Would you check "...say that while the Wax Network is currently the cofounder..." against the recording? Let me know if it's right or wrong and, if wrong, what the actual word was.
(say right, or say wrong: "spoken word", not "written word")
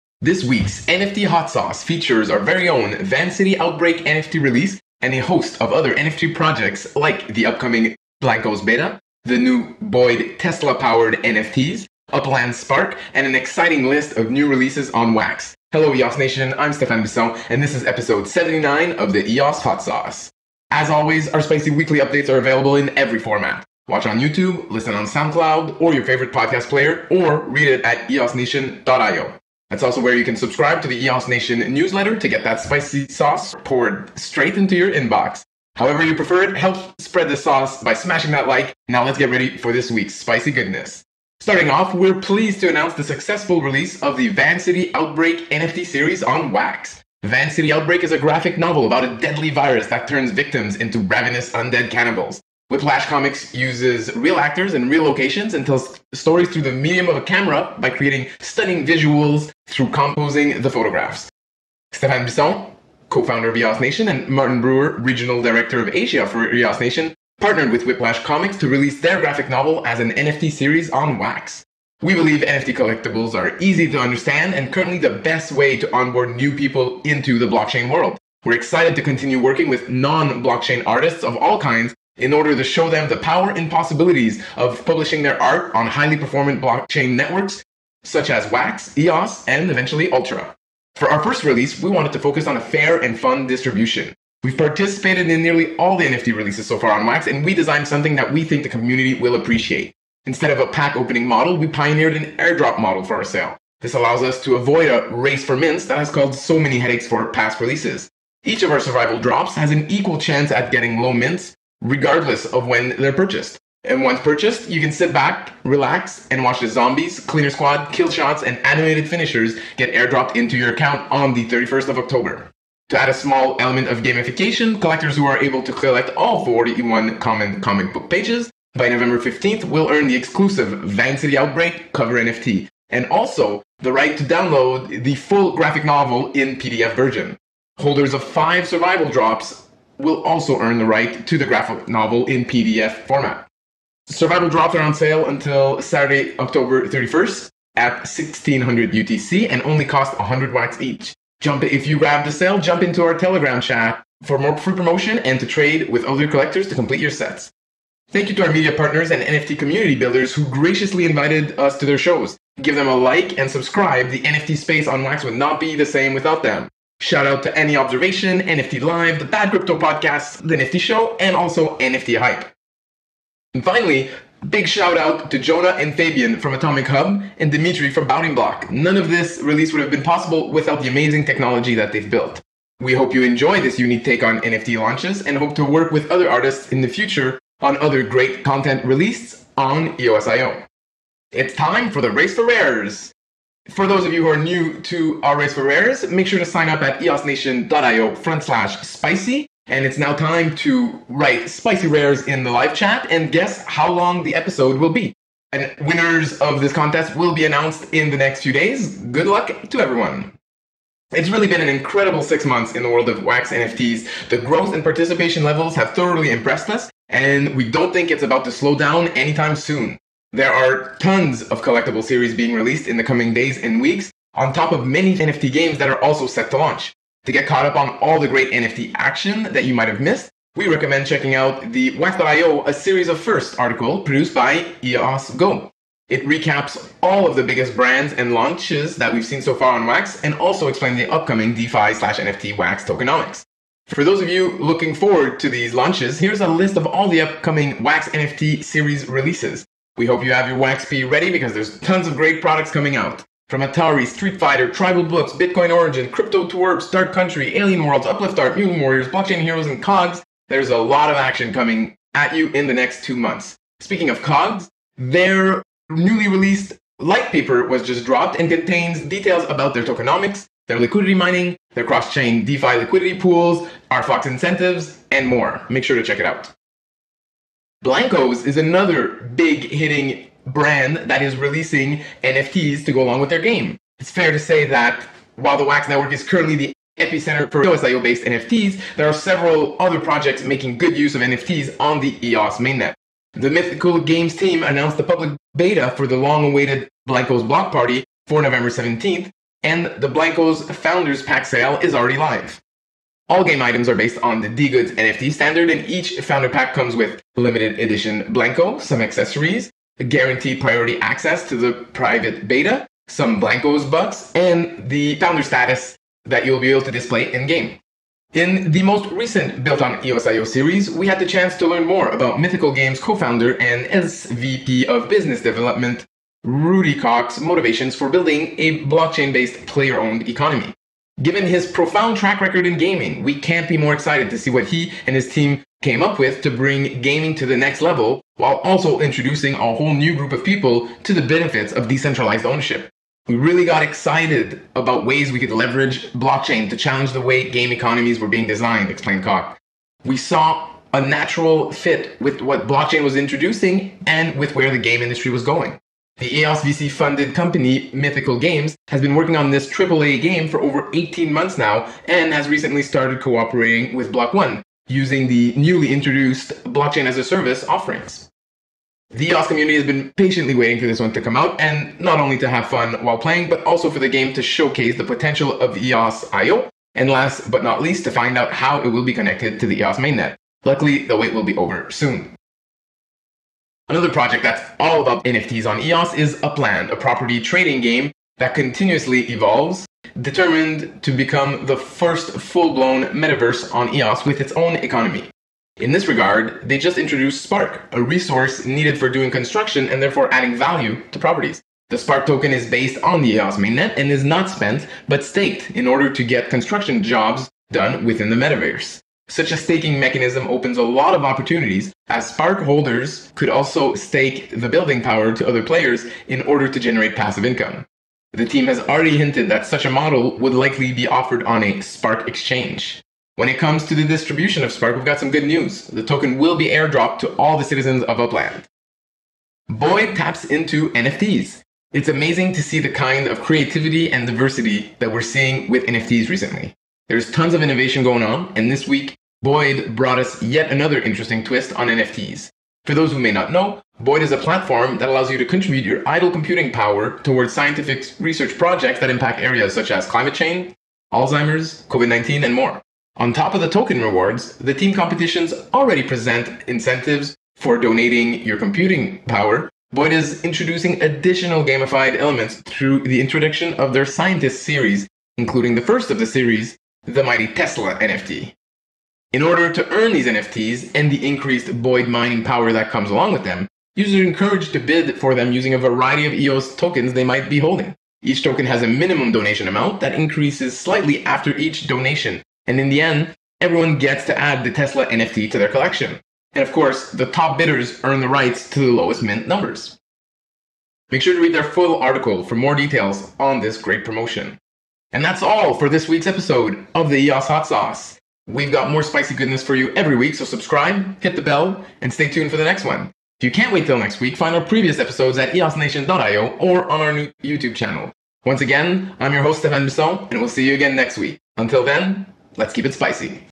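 wrong: "epicenter", not "cofounder".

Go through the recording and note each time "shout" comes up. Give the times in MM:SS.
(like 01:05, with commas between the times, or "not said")
02:47, 02:54.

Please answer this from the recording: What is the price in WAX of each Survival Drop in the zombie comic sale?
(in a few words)
100 WAX.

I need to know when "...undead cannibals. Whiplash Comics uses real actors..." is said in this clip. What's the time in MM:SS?
00:51.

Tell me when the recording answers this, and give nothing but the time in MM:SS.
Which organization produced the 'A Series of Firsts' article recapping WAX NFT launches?
03:54.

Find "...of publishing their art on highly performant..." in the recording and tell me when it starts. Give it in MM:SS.
01:24.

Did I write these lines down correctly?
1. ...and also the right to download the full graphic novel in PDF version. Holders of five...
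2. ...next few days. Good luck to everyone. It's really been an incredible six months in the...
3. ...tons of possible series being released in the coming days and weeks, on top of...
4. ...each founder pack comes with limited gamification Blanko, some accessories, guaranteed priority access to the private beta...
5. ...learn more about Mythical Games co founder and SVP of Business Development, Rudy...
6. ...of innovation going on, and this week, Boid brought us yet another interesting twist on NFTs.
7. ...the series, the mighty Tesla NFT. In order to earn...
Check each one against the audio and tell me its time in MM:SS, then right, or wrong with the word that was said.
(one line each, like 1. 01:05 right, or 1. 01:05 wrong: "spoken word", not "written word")
1. 02:12 right
2. 03:28 right
3. 03:40 wrong: "collectible", not "possible"
4. 05:05 wrong: "edition", not "gamification"
5. 05:21 right
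6. 07:17 right
7. 07:46 right.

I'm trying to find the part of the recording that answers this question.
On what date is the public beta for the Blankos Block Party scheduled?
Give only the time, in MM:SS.
04:58.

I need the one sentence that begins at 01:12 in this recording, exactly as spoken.
We believe NFT collectibles are easy to understand and currently the best way to onboard new people into the blockchain world.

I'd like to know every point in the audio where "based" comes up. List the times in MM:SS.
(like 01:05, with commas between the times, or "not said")
04:48, 05:03, 05:29, 06:42.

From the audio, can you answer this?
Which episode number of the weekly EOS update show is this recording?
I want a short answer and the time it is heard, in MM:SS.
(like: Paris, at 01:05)
79, at 00:17.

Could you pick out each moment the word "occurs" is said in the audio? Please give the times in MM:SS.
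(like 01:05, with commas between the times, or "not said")
not said.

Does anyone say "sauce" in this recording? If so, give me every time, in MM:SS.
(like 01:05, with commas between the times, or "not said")
00:01, 00:19, 00:33, 00:37, 08:17.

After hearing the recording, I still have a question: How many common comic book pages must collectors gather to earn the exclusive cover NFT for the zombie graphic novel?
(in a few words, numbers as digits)
41.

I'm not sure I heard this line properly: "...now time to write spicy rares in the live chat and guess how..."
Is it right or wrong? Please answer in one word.
right.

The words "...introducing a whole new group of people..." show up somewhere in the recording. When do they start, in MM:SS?
05:38.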